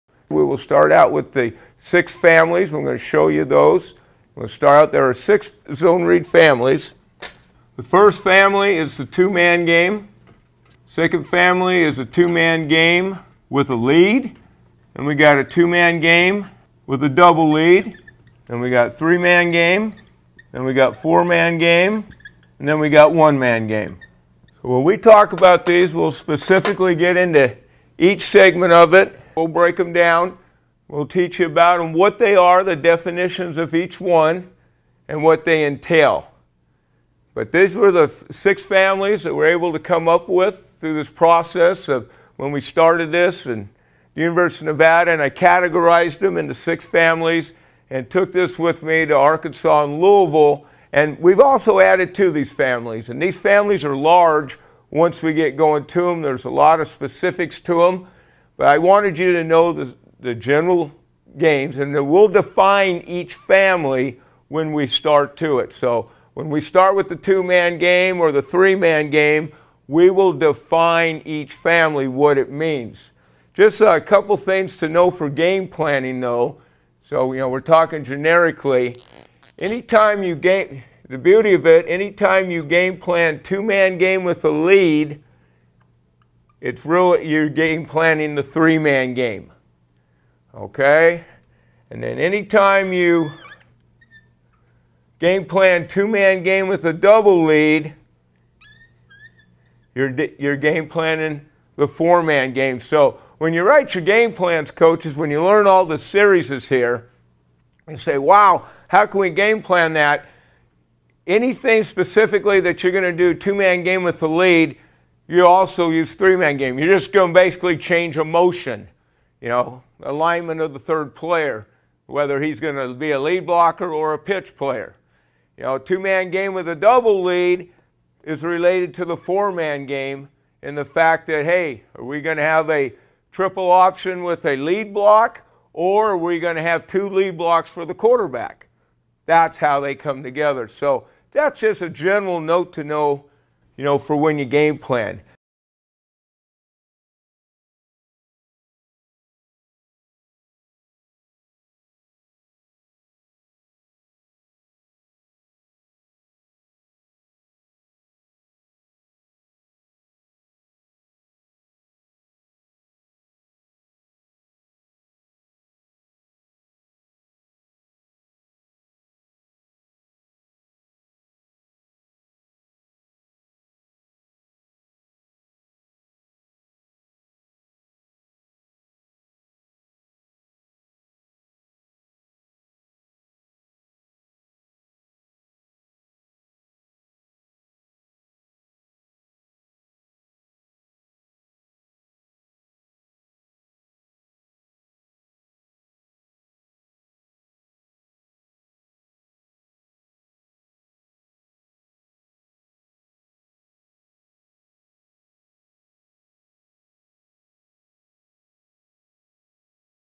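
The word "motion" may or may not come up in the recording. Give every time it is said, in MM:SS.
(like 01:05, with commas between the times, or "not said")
01:58.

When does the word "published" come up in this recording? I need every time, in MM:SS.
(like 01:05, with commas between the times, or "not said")
not said.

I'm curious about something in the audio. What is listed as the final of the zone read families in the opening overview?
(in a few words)
one-man game.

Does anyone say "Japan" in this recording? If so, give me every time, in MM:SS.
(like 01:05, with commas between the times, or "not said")
not said.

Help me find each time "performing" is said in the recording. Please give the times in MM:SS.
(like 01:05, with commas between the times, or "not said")
not said.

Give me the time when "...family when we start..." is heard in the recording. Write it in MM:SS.
01:03.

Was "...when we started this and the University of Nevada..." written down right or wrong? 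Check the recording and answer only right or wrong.
right.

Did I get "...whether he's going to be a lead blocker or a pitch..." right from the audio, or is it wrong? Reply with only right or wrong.
right.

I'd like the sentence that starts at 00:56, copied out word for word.
There's a lot of specifics to them.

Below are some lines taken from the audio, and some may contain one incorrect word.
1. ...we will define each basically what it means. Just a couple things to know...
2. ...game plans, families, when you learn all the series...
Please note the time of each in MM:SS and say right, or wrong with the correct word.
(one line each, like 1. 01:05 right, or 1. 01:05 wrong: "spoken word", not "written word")
1. 01:09 wrong: "family", not "basically"
2. 01:44 wrong: "coaches", not "families".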